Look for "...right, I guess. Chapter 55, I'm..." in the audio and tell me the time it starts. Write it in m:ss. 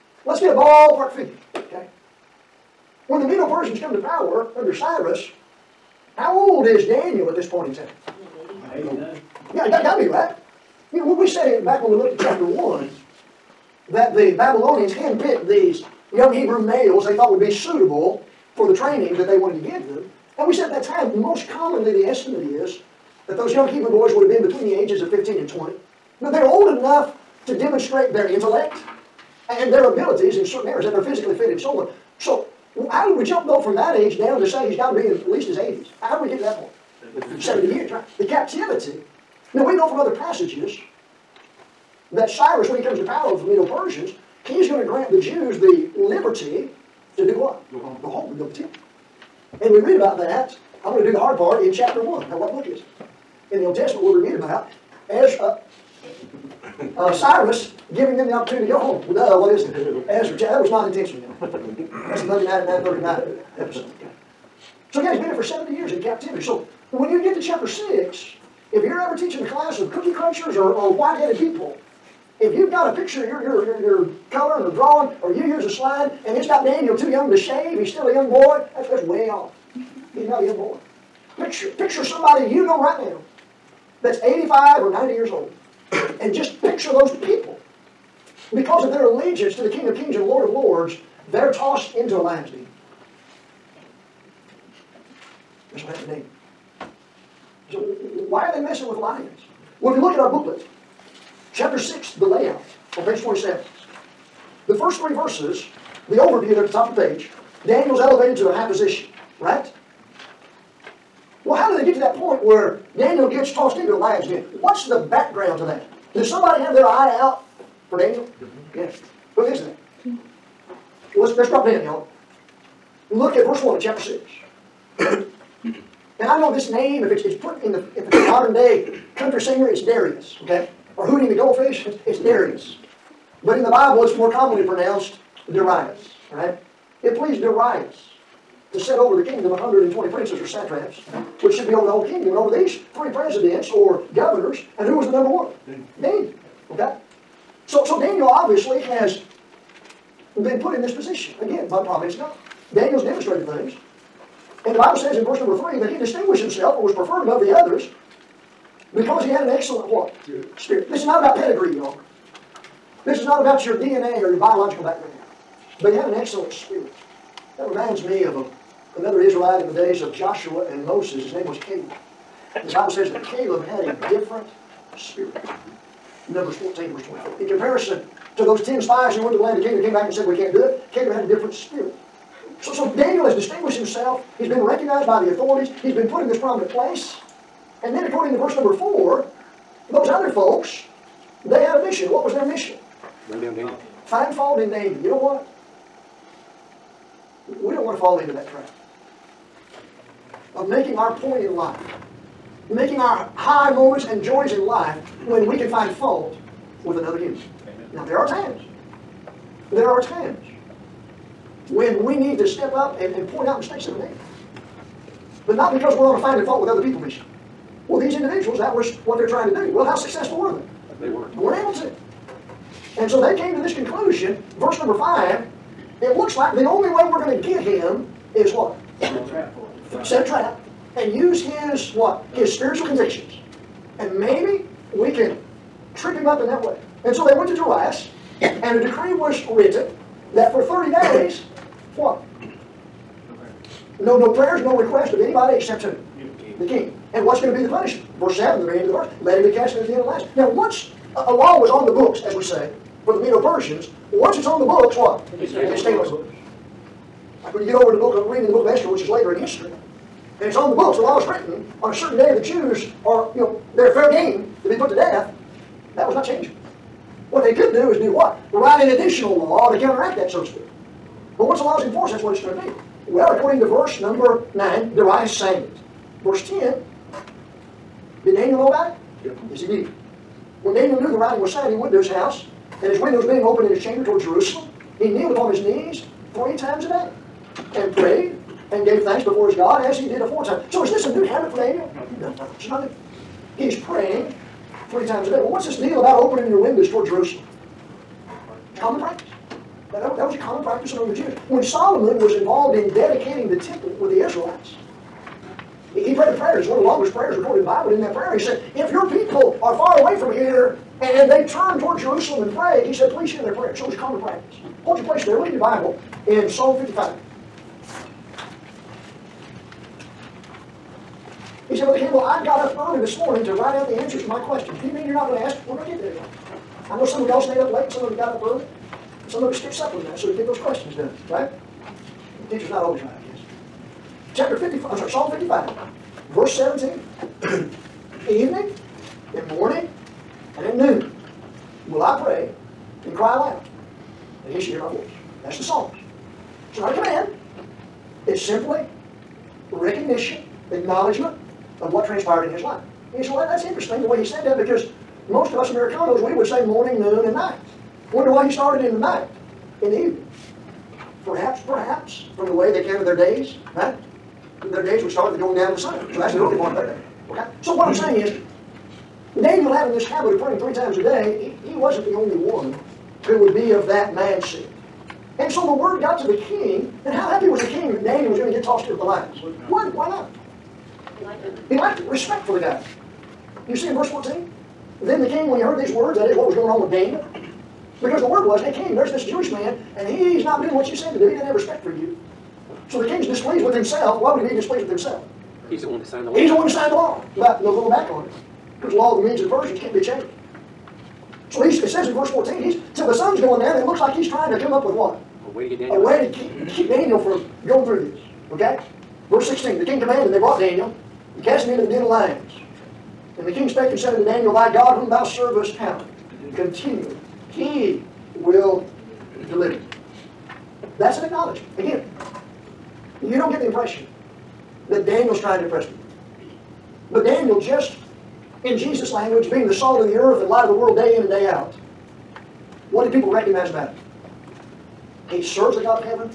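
5:33.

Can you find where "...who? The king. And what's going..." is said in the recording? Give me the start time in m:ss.
4:05.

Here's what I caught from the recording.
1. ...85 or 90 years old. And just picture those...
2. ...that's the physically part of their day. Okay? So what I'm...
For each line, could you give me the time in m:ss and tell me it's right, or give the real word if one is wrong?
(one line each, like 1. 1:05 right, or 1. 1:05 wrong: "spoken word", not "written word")
1. 1:24 right
2. 6:06 wrong: "early", not "physically".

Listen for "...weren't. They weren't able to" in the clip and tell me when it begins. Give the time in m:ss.
3:41.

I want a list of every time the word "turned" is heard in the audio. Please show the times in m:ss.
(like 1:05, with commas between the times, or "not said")
5:11.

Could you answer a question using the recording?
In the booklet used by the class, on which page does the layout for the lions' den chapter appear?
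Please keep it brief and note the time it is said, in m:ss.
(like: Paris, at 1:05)
27, at 1:43.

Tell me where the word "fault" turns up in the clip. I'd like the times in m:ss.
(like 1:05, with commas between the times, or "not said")
3:14, 3:25, 3:36.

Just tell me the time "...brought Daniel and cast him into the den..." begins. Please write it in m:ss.
6:50.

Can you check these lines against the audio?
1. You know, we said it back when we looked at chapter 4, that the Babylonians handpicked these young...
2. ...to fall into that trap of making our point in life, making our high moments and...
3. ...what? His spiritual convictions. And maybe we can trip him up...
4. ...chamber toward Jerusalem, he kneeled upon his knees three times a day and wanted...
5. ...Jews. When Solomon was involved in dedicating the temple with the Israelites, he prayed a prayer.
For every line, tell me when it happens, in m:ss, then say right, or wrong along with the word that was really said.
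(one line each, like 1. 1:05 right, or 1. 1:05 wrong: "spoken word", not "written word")
1. 0:10 wrong: "1", not "4"
2. 3:17 right
3. 3:51 right
4. 4:43 wrong: "prayed", not "wanted"
5. 5:01 right.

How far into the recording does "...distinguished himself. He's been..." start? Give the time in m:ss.
3:03.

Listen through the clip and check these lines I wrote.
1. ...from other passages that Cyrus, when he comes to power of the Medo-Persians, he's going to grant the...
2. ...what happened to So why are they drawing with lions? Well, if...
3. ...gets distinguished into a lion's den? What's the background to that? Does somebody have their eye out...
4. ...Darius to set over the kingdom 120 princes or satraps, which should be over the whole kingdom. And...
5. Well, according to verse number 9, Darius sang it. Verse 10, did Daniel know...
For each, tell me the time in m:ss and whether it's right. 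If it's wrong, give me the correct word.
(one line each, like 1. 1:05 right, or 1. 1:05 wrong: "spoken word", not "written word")
1. 0:39 right
2. 1:35 wrong: "messing", not "drawing"
3. 1:53 wrong: "tossed", not "distinguished"
4. 2:17 right
5. 4:33 right.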